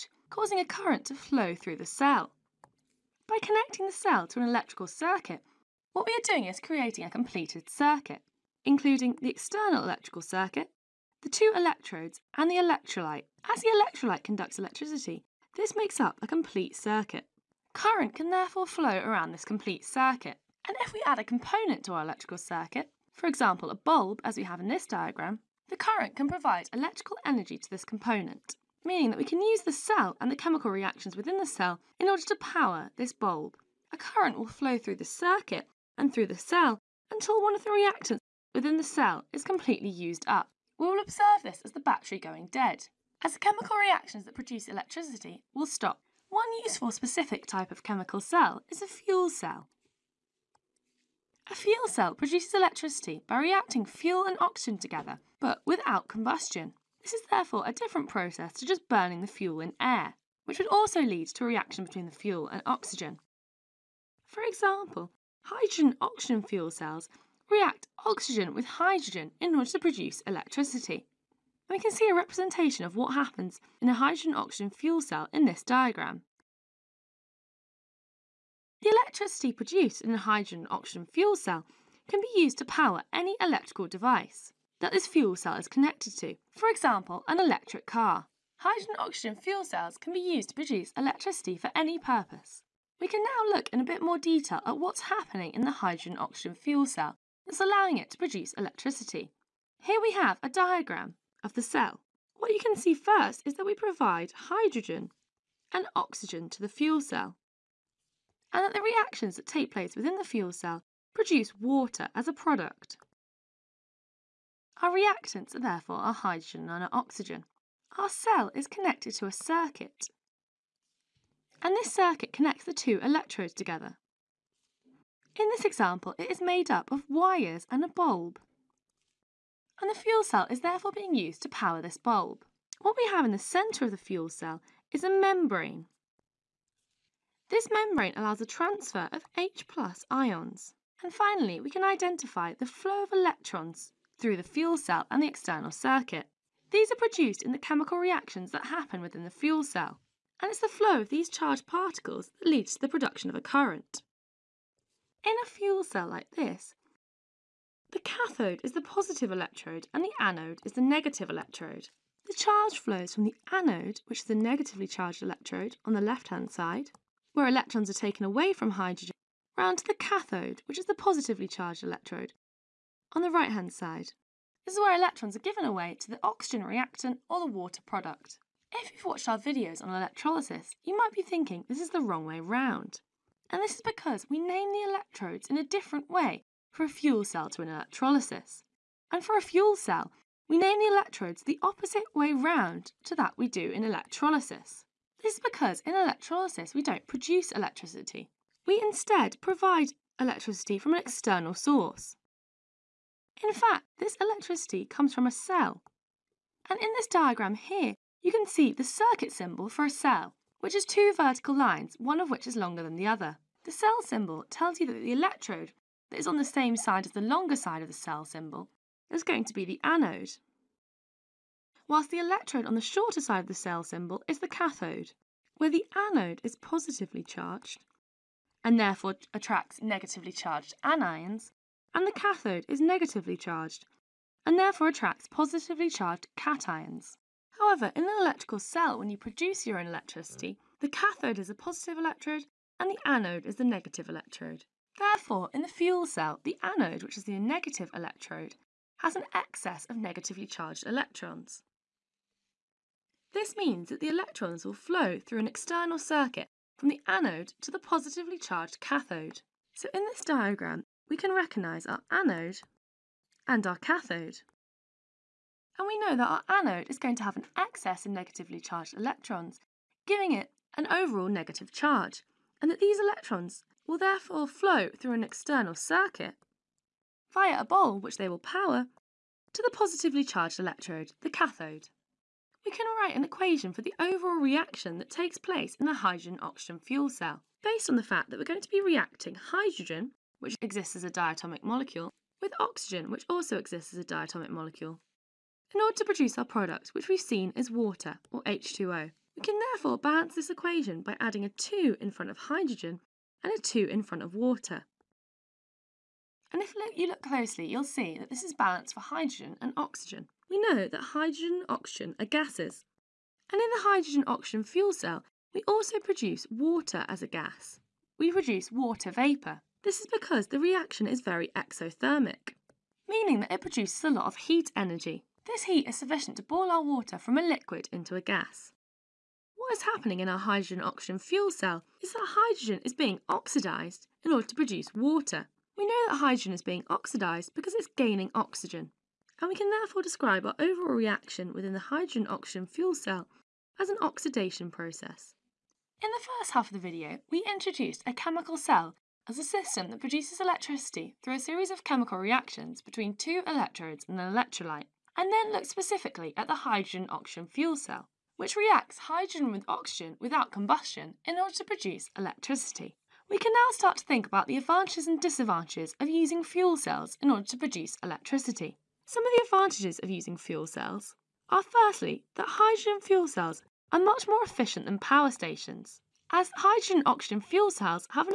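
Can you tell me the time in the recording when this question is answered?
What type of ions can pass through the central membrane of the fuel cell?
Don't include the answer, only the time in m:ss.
2:19.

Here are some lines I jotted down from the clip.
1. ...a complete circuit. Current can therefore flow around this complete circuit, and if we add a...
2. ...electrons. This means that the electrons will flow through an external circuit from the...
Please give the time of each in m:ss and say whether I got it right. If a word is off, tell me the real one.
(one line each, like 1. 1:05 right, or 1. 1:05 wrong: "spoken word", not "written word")
1. 0:16 right
2. 4:10 right.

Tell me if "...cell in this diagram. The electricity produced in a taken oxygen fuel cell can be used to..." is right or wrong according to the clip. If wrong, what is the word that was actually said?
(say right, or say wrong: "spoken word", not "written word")
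wrong: "hydrogen", not "taken".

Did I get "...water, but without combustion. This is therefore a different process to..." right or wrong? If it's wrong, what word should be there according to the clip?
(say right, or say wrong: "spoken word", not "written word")
wrong: "together", not "water".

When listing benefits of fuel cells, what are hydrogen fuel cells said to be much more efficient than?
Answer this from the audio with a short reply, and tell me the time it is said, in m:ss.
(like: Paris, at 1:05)
Power stations, at 6:15.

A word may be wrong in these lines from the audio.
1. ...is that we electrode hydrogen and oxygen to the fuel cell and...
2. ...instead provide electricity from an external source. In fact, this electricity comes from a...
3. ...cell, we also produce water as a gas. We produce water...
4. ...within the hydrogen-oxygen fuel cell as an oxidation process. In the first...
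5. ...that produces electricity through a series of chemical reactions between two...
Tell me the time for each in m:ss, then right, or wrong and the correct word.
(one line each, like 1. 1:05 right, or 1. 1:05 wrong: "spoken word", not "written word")
1. 1:43 wrong: "provide", not "electrode"
2. 3:18 right
3. 5:14 right
4. 5:41 right
5. 5:49 right.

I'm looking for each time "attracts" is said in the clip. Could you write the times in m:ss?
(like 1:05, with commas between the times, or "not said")
3:49, 3:54.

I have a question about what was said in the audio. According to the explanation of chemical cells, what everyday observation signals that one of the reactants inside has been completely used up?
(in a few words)
The battery going dead.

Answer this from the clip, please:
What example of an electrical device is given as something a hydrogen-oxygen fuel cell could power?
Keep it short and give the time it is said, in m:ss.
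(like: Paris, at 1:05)
An electric car, at 1:27.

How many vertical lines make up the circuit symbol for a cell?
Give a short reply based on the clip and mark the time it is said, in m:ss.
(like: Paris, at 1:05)
2, at 3:30.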